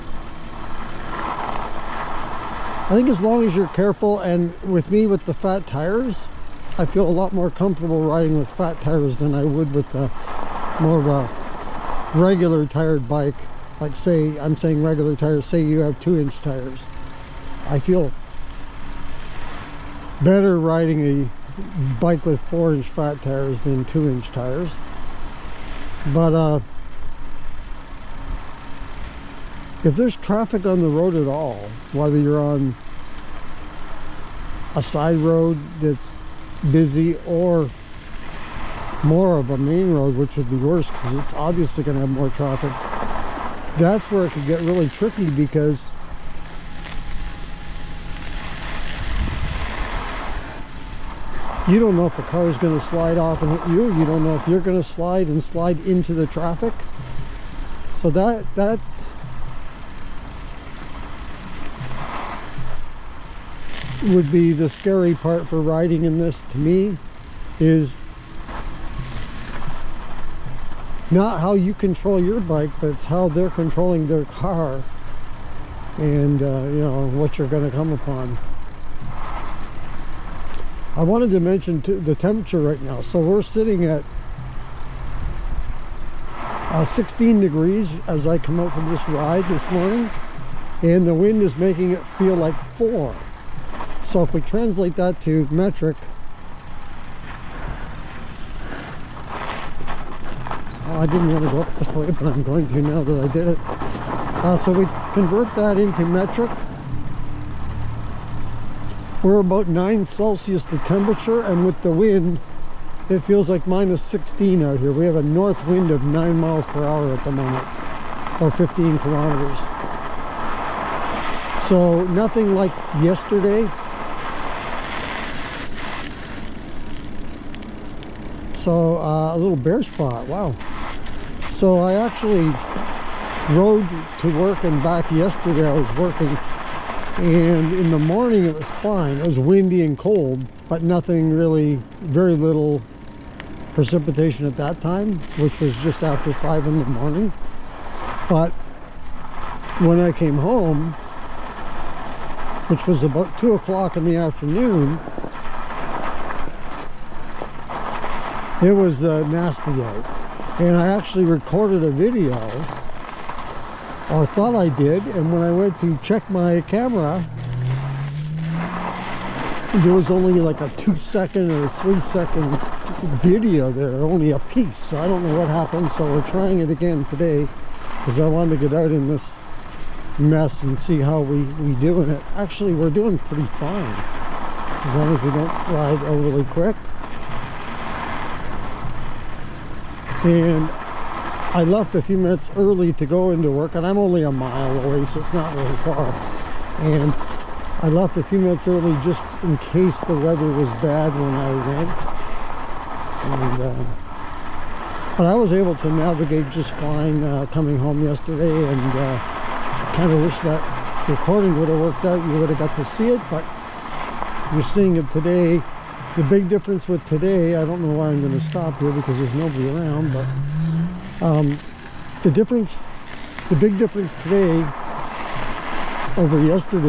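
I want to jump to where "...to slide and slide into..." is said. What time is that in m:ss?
0:54.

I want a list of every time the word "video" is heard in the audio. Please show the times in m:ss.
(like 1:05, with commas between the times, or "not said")
2:41, 2:53.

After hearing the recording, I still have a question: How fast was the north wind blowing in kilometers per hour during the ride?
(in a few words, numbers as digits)
15.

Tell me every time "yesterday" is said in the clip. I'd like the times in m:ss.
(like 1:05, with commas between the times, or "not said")
2:03, 2:15, 3:28.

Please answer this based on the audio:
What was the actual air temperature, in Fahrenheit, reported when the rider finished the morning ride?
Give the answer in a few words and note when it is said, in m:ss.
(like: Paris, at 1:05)
16 degrees, at 1:26.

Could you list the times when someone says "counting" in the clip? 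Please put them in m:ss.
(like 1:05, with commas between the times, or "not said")
not said.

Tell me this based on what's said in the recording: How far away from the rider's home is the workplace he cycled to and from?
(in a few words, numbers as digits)
1 mile.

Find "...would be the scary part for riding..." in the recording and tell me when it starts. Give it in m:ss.
1:04.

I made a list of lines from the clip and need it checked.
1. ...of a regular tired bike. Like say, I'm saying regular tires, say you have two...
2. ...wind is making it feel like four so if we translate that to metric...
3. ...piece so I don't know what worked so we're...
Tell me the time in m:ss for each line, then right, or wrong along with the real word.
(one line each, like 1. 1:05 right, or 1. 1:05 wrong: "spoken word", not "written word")
1. 0:11 right
2. 1:31 right
3. 2:54 wrong: "happened", not "worked".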